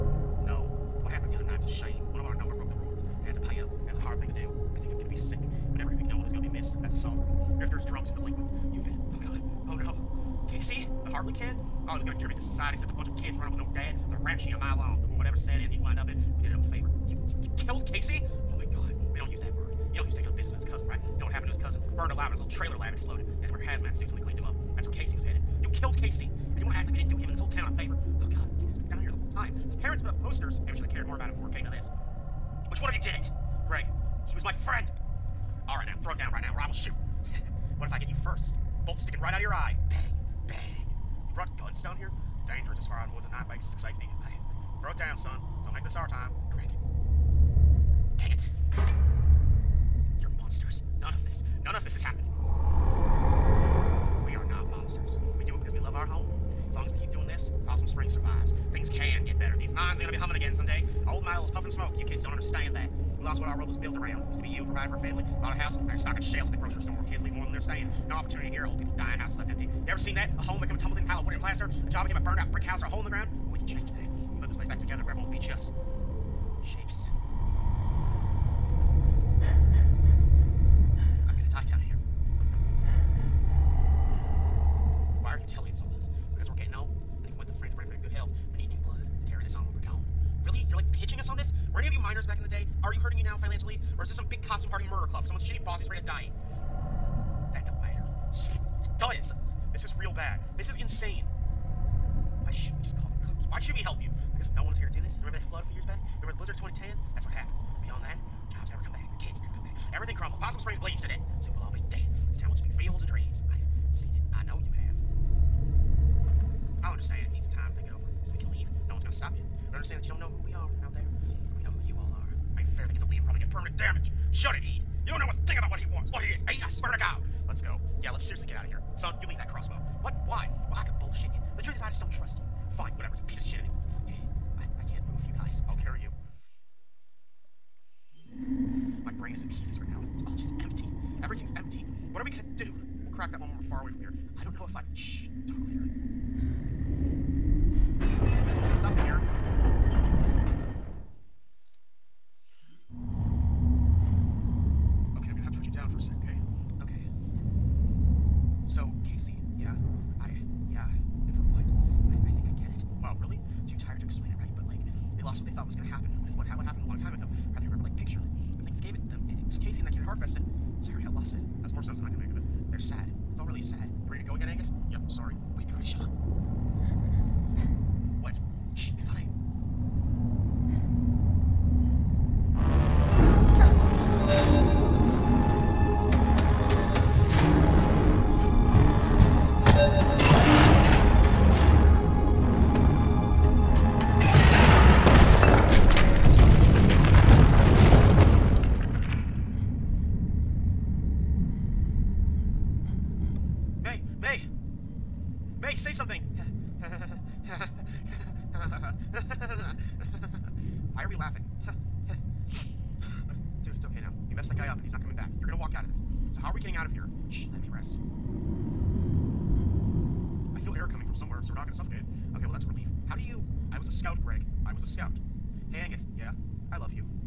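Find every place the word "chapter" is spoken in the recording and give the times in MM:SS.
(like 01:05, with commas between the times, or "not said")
not said.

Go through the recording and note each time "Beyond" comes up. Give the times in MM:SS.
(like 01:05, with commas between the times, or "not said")
01:47.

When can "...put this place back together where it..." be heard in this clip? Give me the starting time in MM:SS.
01:14.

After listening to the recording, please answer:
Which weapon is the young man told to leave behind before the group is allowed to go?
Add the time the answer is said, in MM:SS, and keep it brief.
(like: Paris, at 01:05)
Crossbow, at 02:09.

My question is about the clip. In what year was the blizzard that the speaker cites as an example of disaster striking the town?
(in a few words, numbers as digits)
2010.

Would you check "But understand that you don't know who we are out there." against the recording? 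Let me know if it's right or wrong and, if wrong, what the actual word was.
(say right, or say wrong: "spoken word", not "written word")
right.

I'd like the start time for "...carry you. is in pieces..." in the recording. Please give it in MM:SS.
02:15.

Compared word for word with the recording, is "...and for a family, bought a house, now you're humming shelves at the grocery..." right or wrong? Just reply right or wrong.
wrong.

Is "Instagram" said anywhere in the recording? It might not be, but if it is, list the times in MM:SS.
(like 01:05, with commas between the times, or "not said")
not said.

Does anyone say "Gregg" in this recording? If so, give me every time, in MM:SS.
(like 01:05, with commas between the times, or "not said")
00:33, 00:46.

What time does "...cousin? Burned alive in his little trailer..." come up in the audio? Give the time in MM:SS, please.
00:21.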